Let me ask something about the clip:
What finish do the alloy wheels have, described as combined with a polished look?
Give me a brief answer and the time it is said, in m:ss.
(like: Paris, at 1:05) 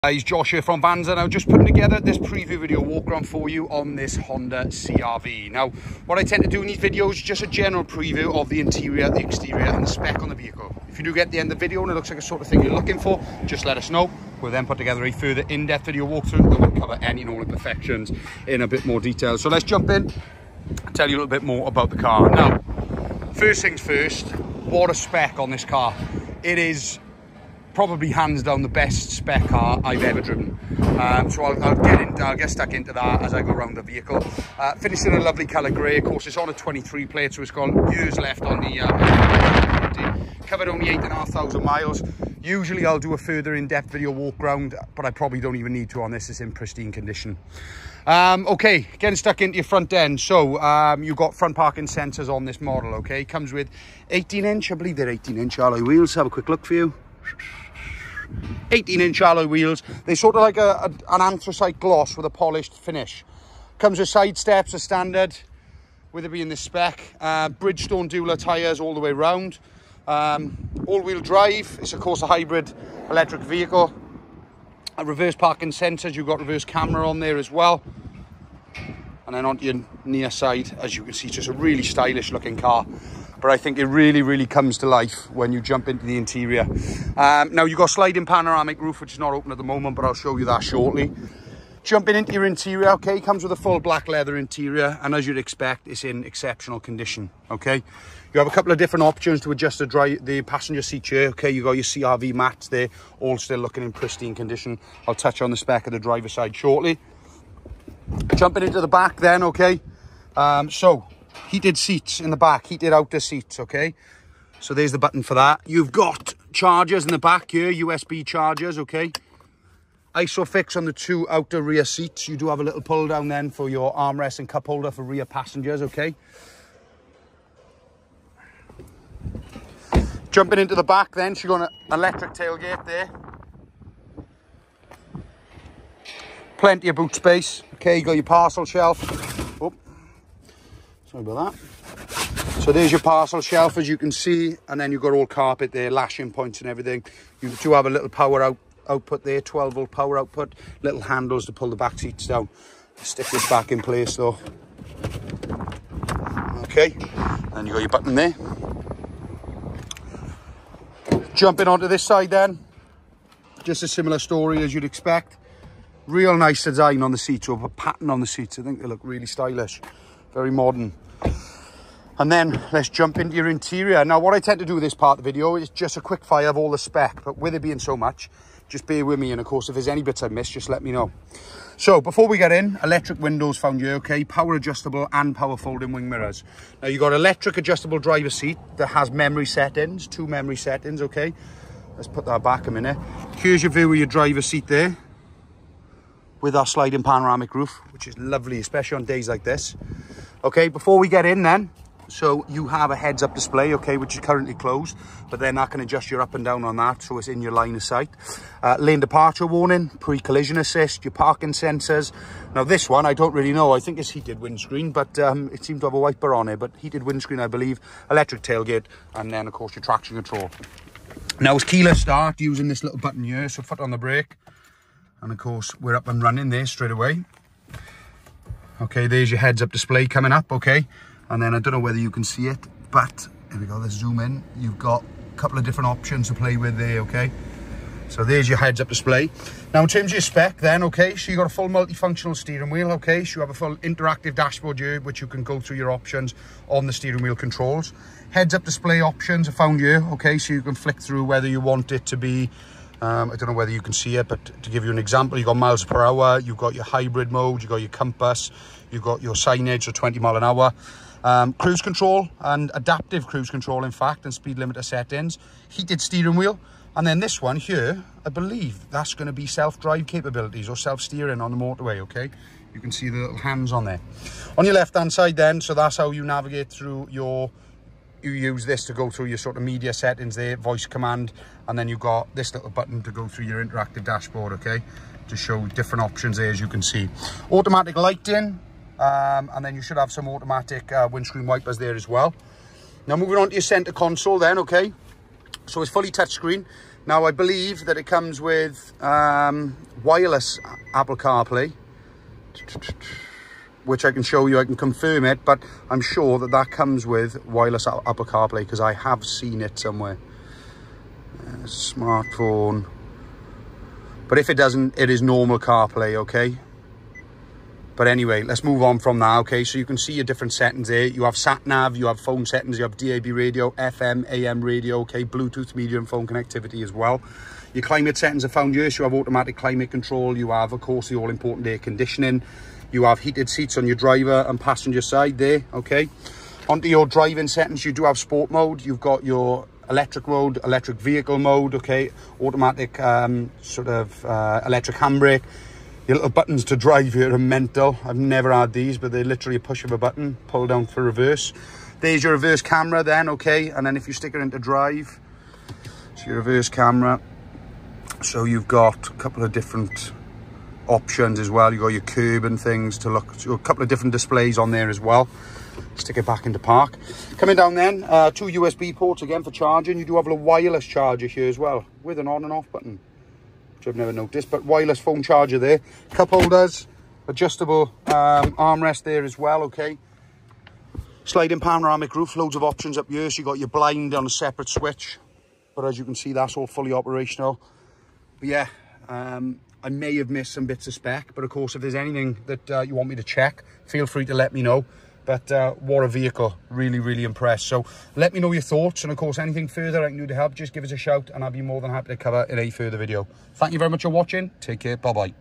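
anthracite gloss, at 1:01.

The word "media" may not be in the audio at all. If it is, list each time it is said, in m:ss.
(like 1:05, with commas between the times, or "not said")
4:39, 5:25.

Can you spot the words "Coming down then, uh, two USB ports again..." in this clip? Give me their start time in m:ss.
6:07.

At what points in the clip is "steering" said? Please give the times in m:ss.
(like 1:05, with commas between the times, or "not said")
4:02, 4:06, 4:25, 4:30.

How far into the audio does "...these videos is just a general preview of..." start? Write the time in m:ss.
0:06.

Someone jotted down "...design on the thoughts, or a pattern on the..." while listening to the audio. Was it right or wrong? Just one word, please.
wrong.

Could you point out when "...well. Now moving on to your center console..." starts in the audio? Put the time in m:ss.
4:52.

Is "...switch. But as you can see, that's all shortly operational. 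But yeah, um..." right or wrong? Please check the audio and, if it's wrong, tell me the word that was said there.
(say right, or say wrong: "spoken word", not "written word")
wrong: "fully", not "shortly".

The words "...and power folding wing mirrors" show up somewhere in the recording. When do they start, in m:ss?
3:05.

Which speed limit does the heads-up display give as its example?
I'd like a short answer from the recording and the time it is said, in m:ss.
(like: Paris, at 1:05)
20 mph, at 4:19.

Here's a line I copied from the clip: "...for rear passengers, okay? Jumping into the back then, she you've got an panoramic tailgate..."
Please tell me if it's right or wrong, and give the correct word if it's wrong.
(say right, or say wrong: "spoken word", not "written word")
wrong: "electric", not "panoramic".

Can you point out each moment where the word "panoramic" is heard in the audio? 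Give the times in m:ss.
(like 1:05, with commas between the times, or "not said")
1:28, 3:17, 6:21.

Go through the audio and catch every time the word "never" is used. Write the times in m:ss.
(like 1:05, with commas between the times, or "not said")
5:48, 6:13.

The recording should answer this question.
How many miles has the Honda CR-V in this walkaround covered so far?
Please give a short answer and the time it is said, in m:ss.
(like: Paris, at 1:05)
8,500 miles, at 0:40.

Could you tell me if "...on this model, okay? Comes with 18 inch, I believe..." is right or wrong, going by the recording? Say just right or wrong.
right.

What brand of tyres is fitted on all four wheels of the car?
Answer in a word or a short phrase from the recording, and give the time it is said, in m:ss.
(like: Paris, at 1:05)
Bridgestone Dueler, at 1:07.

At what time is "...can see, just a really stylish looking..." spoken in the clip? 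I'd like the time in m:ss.
1:21.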